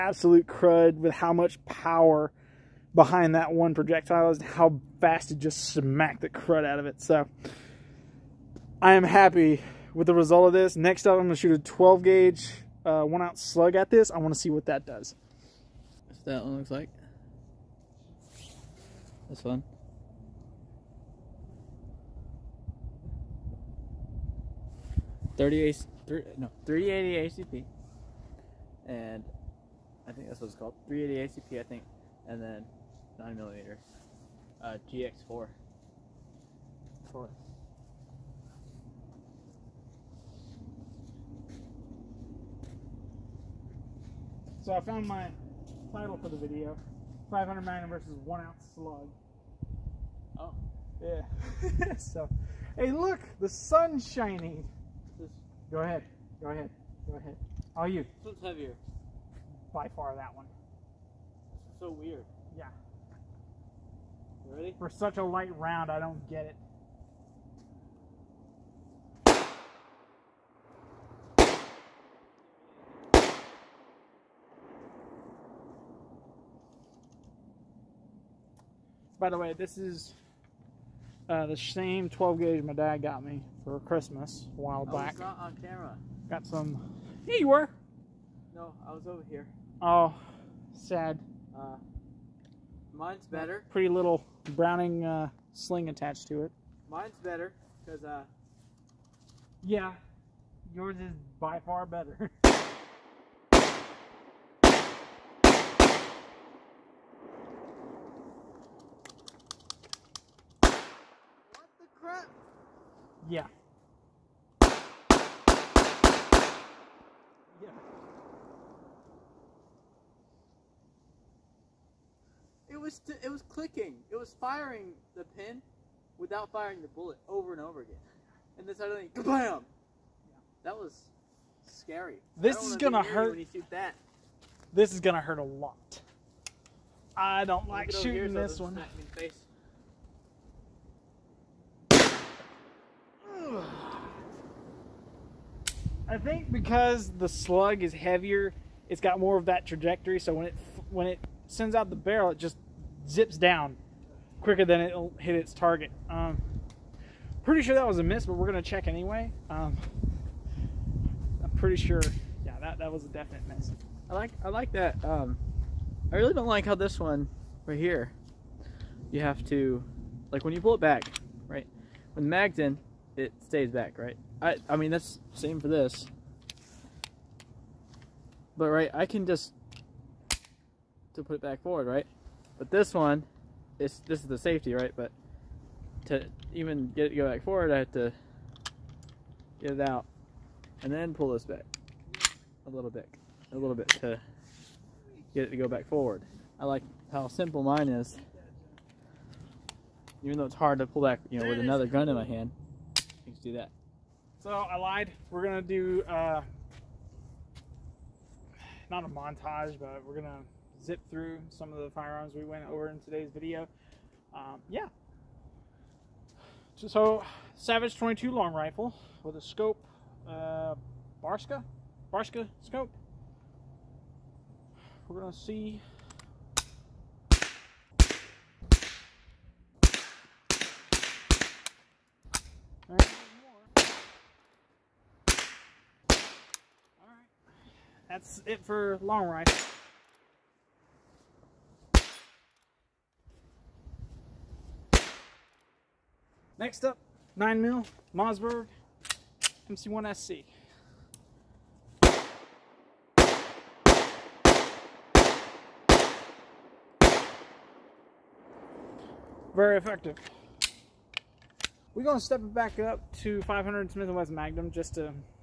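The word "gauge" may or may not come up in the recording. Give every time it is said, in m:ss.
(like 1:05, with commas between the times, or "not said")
0:12, 1:22.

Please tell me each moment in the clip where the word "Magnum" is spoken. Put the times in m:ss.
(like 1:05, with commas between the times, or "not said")
0:47, 4:24.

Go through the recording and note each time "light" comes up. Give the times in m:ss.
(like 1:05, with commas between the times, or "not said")
1:05.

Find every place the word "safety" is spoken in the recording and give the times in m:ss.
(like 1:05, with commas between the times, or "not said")
3:04.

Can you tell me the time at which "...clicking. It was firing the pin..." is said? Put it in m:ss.
2:03.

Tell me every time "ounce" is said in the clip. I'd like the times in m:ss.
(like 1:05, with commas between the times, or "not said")
0:13, 0:48.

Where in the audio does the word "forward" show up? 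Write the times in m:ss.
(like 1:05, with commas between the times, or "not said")
3:01, 3:07, 3:15.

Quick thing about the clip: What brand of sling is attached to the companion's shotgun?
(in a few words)
Browning.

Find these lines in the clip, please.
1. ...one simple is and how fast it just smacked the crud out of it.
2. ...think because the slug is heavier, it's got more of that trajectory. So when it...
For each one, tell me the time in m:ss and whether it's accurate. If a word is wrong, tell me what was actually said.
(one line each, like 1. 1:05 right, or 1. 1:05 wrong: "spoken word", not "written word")
1. 0:03 wrong: "projectile", not "simple"
2. 2:26 right.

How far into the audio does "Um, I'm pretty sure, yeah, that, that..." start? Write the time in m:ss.
2:39.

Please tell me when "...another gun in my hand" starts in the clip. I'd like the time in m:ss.
3:21.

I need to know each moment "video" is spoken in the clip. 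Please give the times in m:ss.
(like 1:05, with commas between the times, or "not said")
0:46, 3:33.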